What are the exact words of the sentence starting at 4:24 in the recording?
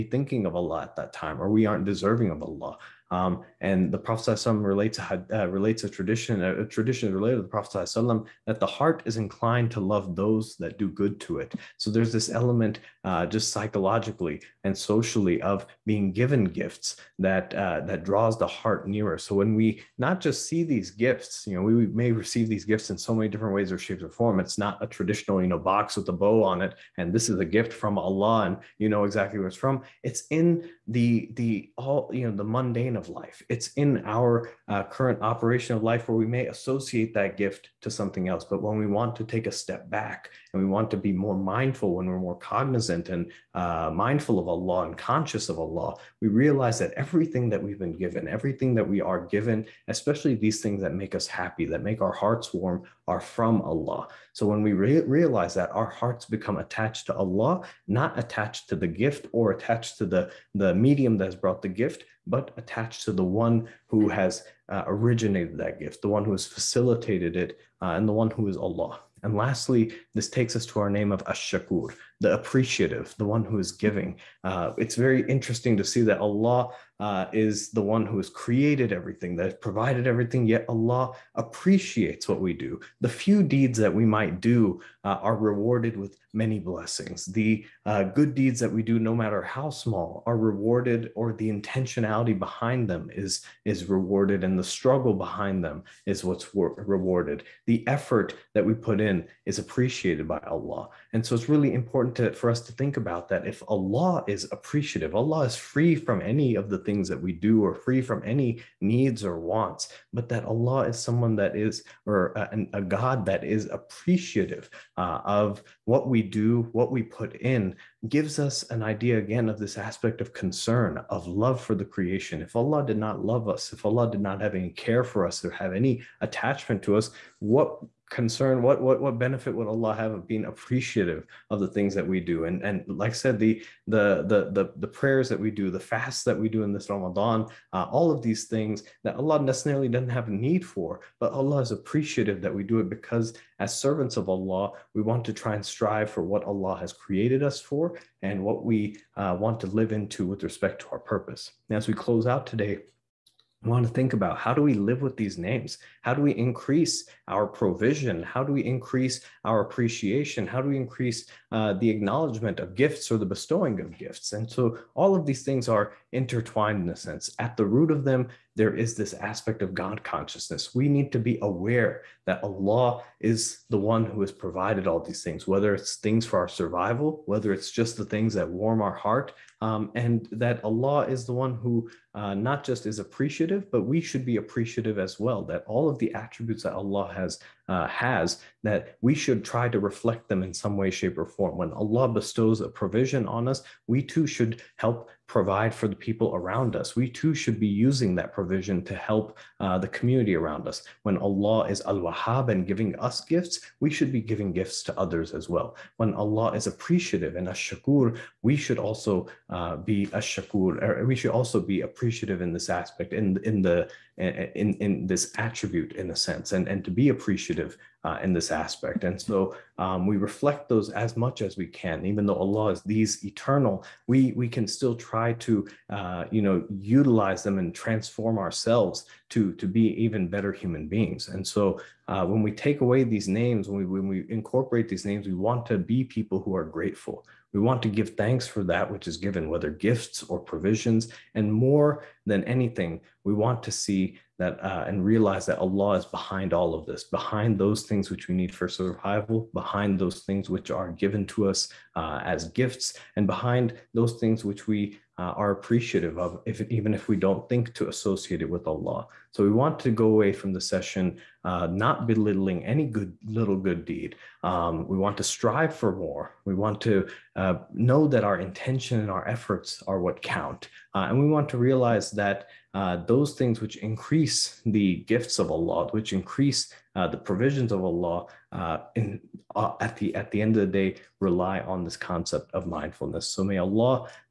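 Um, we want to strive for more.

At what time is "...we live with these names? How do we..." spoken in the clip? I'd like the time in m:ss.
2:34.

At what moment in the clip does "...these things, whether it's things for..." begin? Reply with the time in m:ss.
2:54.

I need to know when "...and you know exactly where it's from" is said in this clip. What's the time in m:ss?
0:28.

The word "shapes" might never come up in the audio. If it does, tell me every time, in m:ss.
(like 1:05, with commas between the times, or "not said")
0:23, 3:10.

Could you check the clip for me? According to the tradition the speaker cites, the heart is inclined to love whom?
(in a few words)
Those that do good to it.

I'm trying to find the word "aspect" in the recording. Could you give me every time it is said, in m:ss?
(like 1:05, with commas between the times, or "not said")
1:59, 2:49, 3:32, 3:38.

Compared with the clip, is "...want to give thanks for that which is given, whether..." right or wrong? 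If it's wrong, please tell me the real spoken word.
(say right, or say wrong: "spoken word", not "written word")
right.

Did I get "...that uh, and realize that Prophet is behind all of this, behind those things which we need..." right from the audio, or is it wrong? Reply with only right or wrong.
wrong.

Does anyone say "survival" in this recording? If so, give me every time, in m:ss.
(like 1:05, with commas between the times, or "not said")
2:56, 4:08.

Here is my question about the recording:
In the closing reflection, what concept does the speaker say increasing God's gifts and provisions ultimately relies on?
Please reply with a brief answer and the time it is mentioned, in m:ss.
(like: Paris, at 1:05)
Mindfulness, at 4:42.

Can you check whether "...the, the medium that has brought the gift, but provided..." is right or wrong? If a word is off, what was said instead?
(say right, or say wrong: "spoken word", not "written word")
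wrong: "attached", not "provided".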